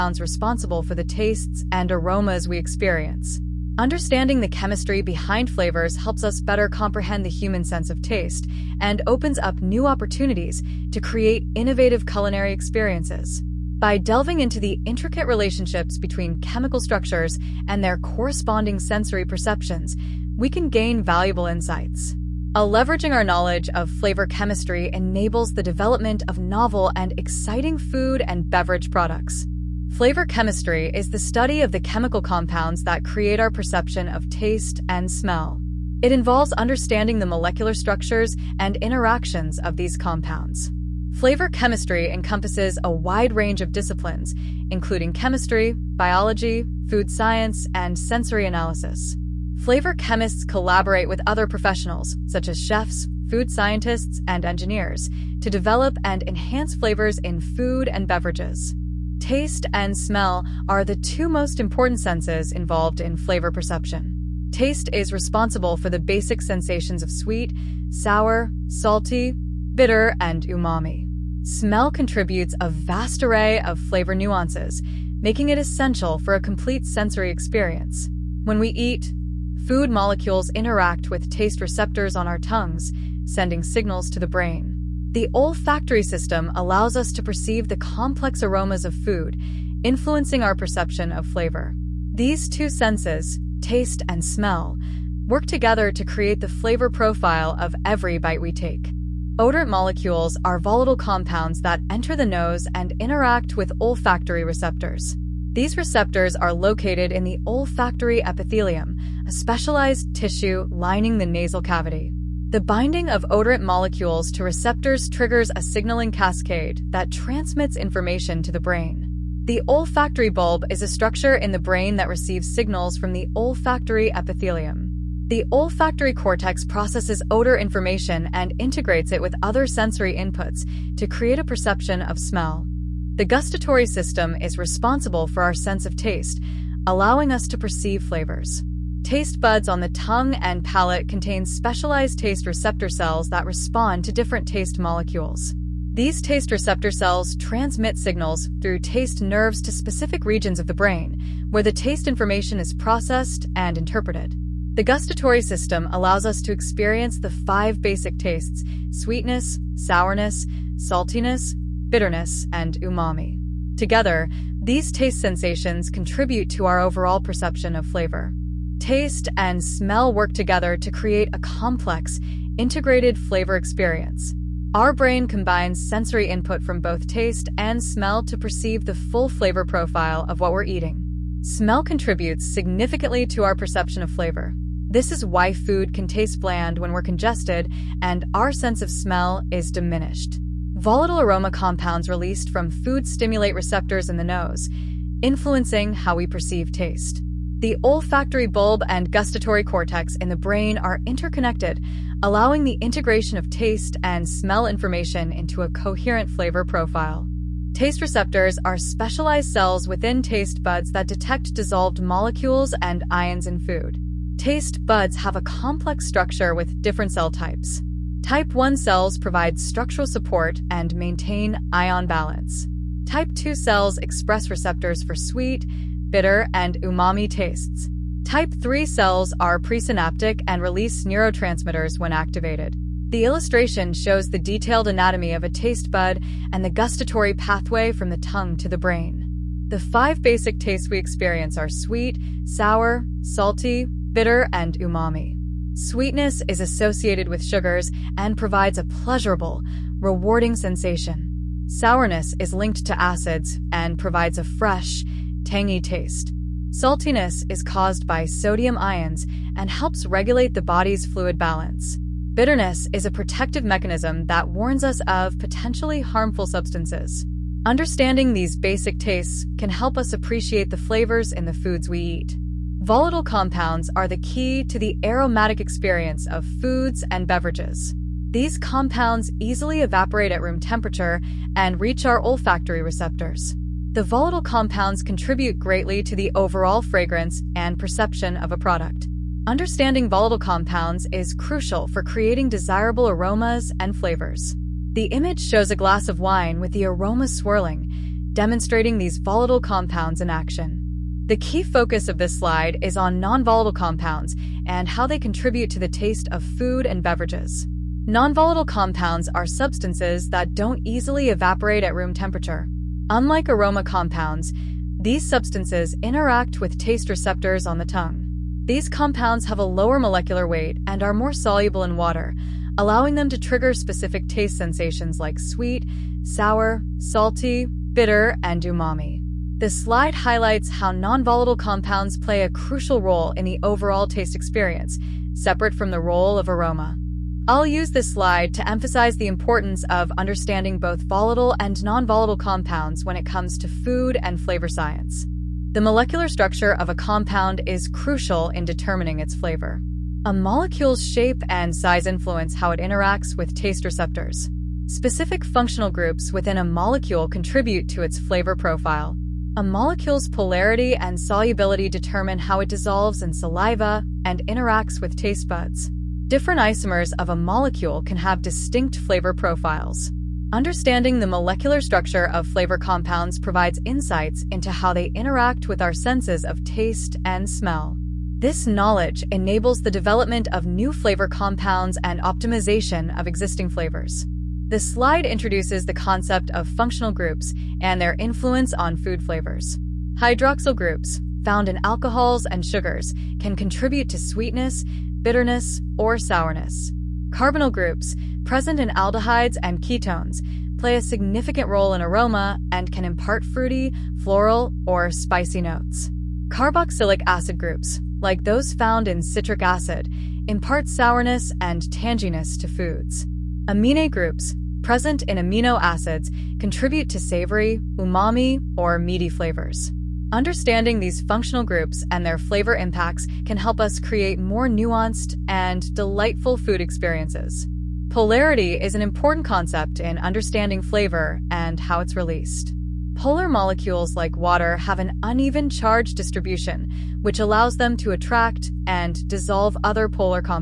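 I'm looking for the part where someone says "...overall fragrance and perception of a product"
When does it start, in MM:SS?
04:46.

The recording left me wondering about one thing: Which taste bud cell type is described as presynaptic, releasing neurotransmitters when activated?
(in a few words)
Type 3 cells.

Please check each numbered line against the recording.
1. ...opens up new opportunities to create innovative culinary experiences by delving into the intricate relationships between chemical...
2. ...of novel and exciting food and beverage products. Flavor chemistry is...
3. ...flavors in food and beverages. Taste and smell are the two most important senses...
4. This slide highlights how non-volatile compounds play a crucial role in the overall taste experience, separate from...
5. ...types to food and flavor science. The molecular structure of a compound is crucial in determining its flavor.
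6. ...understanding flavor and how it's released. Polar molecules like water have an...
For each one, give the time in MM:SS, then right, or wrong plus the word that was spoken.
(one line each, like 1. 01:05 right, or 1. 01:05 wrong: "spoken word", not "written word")
1. 00:09 right
2. 00:26 right
3. 00:56 right
4. 05:29 right
5. 05:43 wrong: "comes", not "types"
6. 07:10 right.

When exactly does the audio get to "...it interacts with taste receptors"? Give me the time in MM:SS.
05:52.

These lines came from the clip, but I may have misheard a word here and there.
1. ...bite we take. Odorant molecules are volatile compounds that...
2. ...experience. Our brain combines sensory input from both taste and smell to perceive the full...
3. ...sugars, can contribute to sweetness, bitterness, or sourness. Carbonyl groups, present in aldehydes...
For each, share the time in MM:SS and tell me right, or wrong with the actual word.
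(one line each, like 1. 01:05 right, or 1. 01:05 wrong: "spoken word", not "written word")
1. 01:38 right
2. 02:53 right
3. 06:32 right.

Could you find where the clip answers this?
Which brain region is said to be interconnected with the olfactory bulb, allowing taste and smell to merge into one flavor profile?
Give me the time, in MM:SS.
03:19.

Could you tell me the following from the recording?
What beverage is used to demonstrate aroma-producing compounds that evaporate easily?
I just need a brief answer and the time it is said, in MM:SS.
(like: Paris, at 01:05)
wine, at 04:55.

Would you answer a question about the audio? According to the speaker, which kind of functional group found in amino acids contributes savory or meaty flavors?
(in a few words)
Amine groups.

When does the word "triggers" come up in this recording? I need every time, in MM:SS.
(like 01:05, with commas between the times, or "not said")
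01:55, 05:23.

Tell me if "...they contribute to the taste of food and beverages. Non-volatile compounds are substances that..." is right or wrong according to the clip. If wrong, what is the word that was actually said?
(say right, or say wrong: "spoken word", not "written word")
right.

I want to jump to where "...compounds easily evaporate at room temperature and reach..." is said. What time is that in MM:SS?
04:38.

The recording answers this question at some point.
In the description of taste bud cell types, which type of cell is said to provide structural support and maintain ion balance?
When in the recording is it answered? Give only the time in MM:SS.
03:38.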